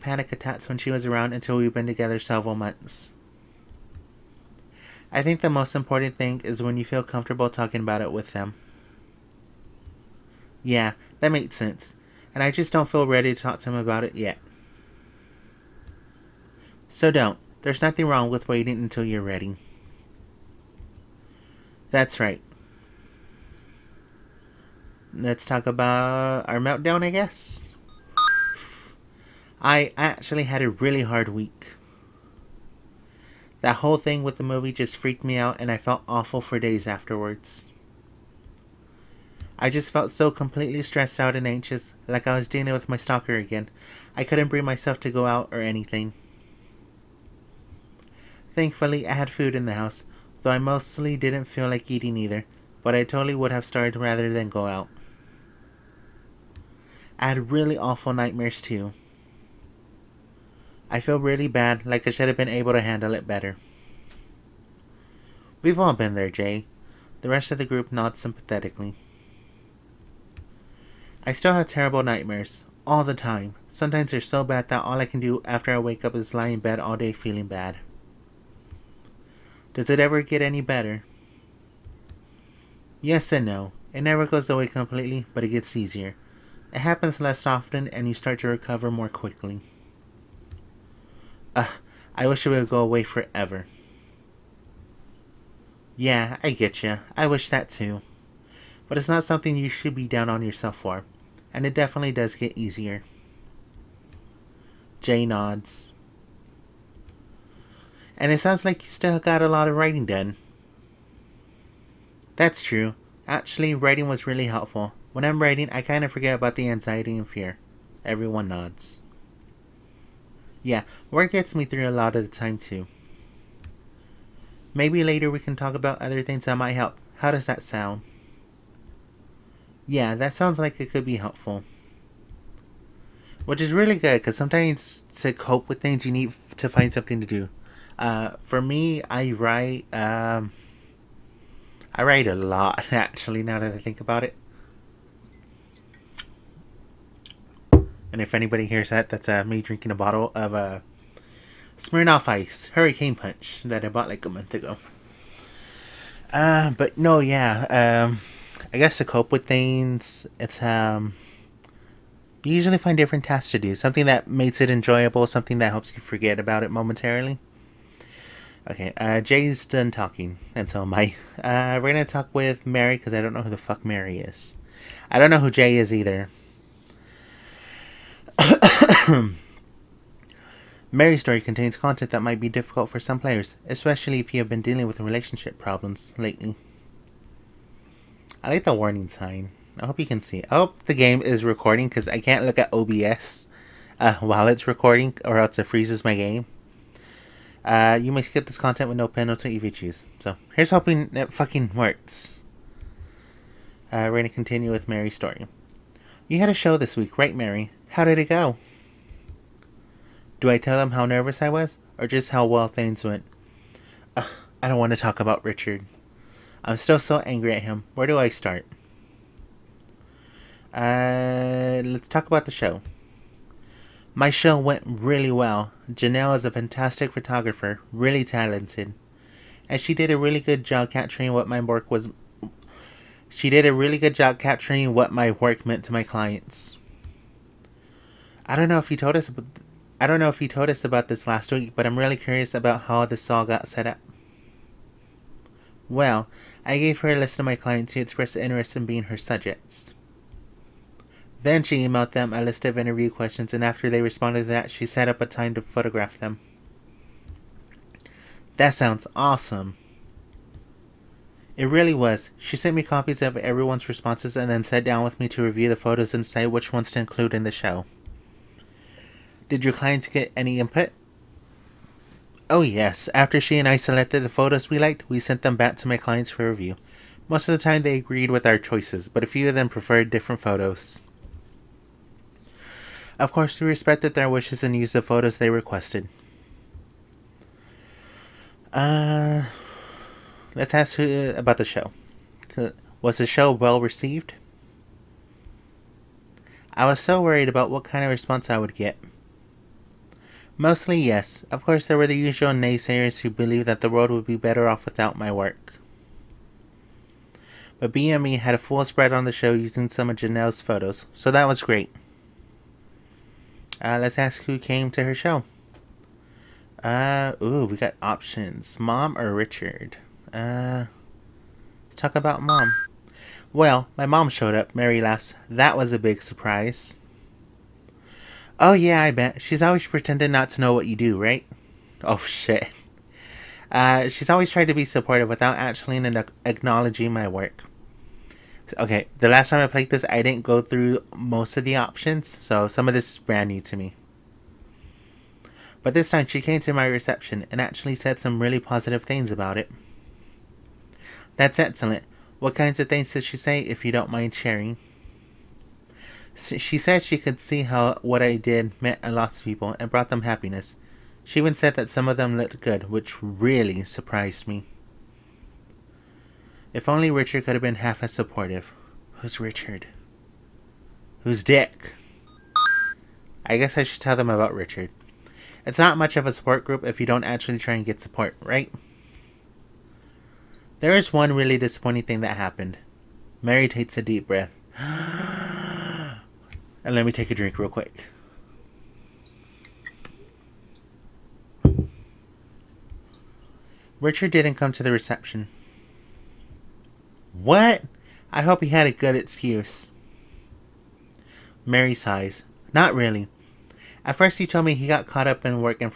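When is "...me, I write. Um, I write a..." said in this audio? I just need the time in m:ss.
2:18.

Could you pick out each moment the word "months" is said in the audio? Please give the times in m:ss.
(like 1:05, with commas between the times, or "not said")
0:02, 2:34.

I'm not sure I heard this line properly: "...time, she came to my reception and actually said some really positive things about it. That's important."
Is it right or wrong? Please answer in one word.
wrong.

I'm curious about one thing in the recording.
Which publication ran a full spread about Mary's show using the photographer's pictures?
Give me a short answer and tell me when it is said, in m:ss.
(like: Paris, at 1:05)
BME, at 5:07.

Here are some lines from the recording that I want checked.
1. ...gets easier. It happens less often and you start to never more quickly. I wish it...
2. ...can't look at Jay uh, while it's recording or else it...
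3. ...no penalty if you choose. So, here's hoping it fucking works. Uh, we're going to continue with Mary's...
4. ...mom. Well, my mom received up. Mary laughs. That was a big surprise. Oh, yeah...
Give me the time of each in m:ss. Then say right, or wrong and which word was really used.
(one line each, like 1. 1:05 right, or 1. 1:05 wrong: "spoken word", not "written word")
1. 1:25 wrong: "recover", not "never"
2. 3:12 wrong: "OBS", not "Jay"
3. 3:18 right
4. 5:22 wrong: "showed", not "received".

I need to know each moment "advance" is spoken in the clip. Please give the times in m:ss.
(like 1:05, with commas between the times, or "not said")
not said.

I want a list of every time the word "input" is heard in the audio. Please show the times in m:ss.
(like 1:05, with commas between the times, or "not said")
4:30.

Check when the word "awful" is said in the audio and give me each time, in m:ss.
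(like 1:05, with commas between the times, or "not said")
0:36, 0:57.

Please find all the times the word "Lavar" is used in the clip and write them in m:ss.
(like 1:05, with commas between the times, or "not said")
not said.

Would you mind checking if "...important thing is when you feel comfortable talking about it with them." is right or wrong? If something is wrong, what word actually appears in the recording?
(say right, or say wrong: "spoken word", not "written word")
right.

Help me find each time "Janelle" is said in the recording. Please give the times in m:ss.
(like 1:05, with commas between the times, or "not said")
3:45, 5:10.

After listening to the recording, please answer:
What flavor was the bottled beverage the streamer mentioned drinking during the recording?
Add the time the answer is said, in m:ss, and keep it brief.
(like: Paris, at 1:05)
Hurricane Punch, at 2:32.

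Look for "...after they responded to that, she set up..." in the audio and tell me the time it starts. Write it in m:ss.
4:13.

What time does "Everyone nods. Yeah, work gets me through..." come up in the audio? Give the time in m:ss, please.
1:58.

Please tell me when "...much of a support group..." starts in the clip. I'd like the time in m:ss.
6:15.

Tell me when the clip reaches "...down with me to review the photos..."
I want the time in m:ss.
4:24.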